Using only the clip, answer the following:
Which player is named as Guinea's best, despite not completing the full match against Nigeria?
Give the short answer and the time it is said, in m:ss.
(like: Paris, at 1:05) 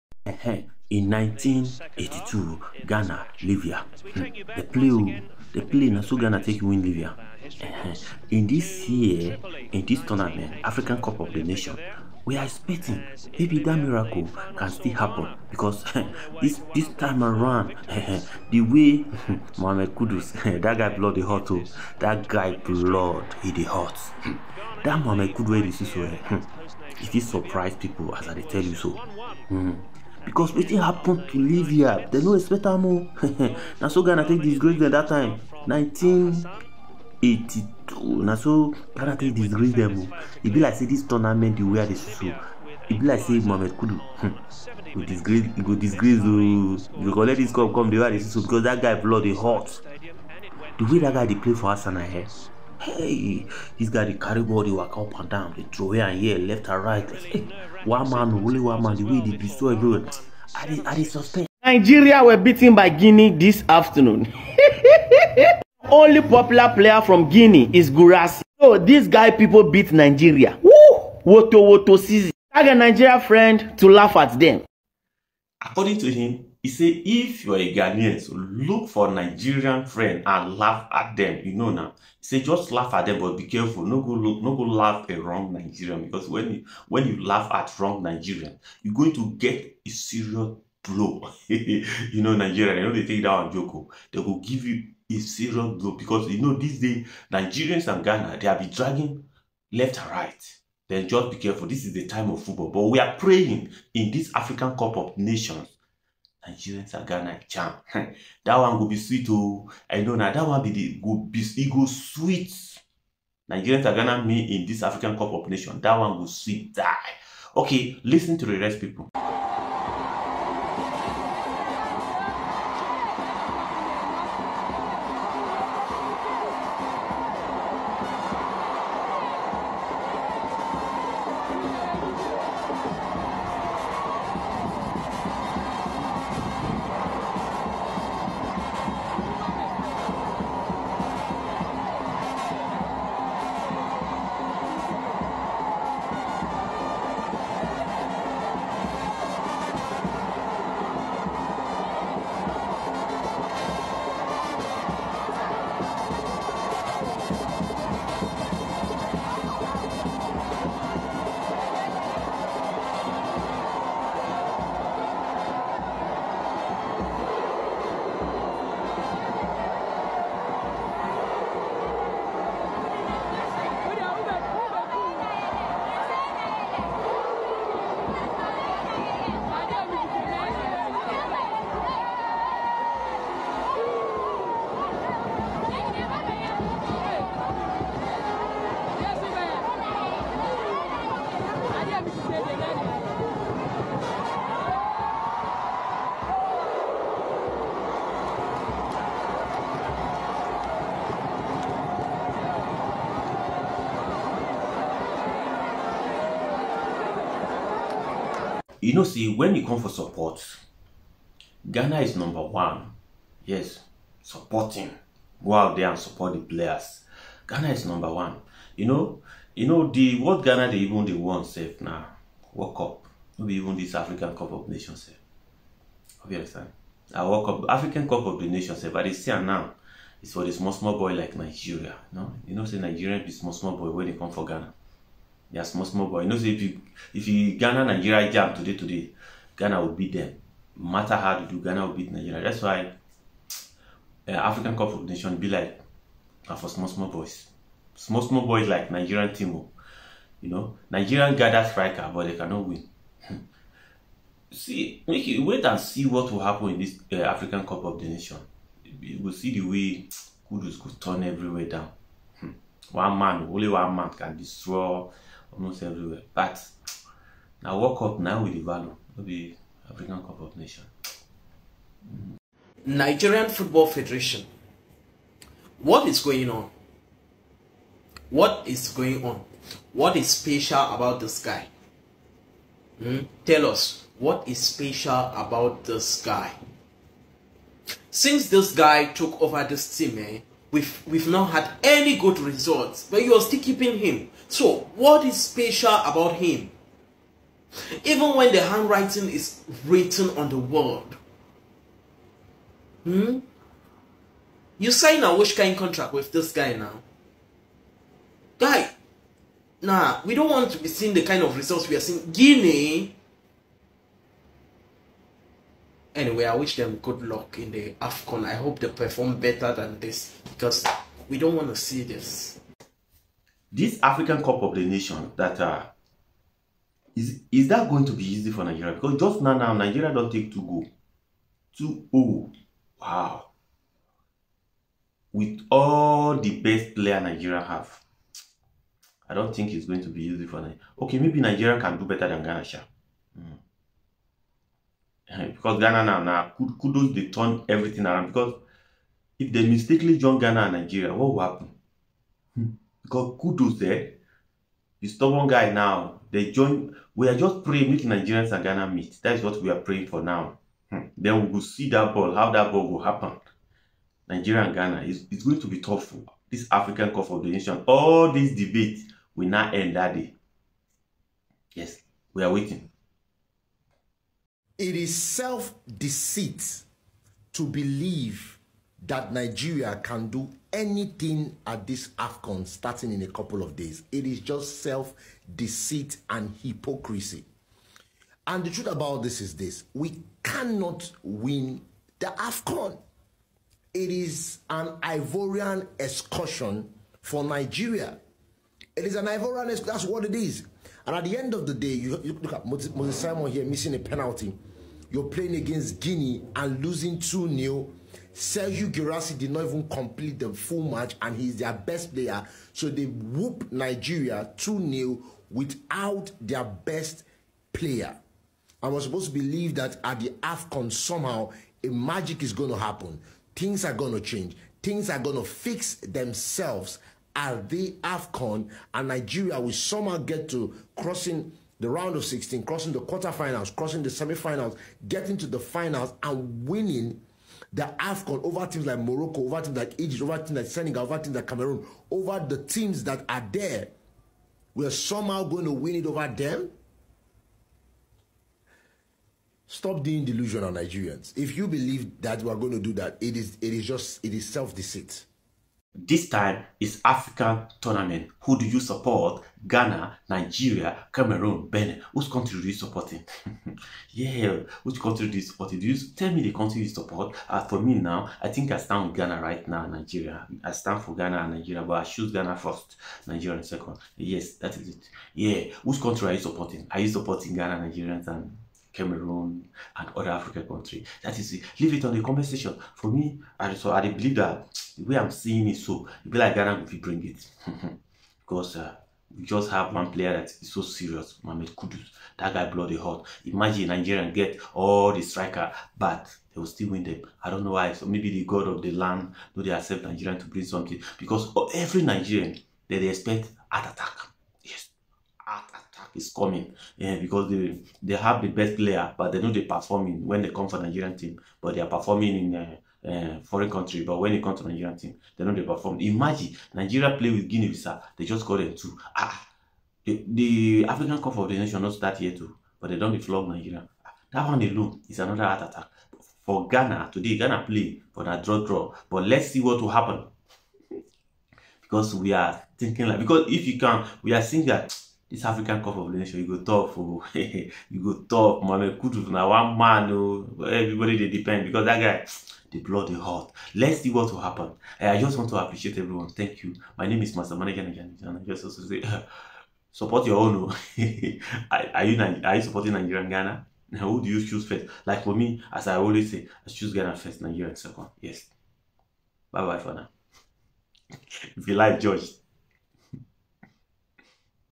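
Sergio Girassi, at 6:48.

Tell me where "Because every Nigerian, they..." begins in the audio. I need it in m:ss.
8:21.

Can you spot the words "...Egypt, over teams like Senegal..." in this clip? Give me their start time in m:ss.
7:19.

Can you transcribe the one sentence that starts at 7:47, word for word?
Uh, for me now, I think I stand with Ghana right now, Nigeria.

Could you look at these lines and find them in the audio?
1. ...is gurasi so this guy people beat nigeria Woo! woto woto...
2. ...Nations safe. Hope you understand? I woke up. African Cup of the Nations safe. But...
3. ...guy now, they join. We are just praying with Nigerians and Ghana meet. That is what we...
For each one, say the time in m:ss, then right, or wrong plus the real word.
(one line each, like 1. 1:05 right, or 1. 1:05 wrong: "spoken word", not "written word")
1. 1:07 right
2. 3:44 right
3. 5:55 right.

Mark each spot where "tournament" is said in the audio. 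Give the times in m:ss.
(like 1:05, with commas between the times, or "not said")
0:10, 0:41, 7:37.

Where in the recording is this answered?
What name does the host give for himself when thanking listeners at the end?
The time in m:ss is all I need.
9:07.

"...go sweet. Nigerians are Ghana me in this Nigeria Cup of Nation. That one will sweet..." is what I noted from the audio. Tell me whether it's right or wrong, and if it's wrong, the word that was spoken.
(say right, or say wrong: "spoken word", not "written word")
wrong: "African", not "Nigeria".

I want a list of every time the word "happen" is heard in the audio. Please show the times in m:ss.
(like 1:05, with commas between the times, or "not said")
0:14, 0:30, 4:16, 5:51, 6:03, 7:02, 8:49, 9:04.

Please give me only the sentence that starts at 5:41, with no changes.
Okay, maybe Nigeria can do better than Ghana.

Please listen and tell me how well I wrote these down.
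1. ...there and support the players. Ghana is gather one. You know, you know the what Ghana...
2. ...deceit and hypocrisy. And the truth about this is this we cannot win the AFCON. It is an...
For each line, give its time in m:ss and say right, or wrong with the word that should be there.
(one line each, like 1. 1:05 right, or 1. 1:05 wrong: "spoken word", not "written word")
1. 3:35 wrong: "number", not "gather"
2. 6:25 right.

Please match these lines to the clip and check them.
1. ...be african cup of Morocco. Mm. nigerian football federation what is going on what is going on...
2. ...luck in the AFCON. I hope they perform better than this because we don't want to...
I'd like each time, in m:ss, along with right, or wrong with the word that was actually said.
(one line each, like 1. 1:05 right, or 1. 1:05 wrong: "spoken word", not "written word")
1. 4:29 wrong: "Nations", not "Morocco"
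2. 5:17 right.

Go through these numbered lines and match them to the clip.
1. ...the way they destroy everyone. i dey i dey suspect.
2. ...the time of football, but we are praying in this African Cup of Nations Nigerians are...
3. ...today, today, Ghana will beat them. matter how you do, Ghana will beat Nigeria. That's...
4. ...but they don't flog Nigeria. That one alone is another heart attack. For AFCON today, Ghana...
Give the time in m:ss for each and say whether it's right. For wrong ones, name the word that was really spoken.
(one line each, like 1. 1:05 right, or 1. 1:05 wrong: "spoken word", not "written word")
1. 0:58 right
2. 1:41 right
3. 3:58 right
4. 8:42 wrong: "Ghana", not "AFCON".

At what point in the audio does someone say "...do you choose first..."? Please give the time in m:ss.
9:14.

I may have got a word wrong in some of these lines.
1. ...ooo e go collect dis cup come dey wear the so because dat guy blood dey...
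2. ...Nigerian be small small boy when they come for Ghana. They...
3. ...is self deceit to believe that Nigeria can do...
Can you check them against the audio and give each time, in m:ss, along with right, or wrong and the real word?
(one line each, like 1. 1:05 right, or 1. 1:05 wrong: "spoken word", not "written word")
1. 0:46 right
2. 3:52 right
3. 6:14 right.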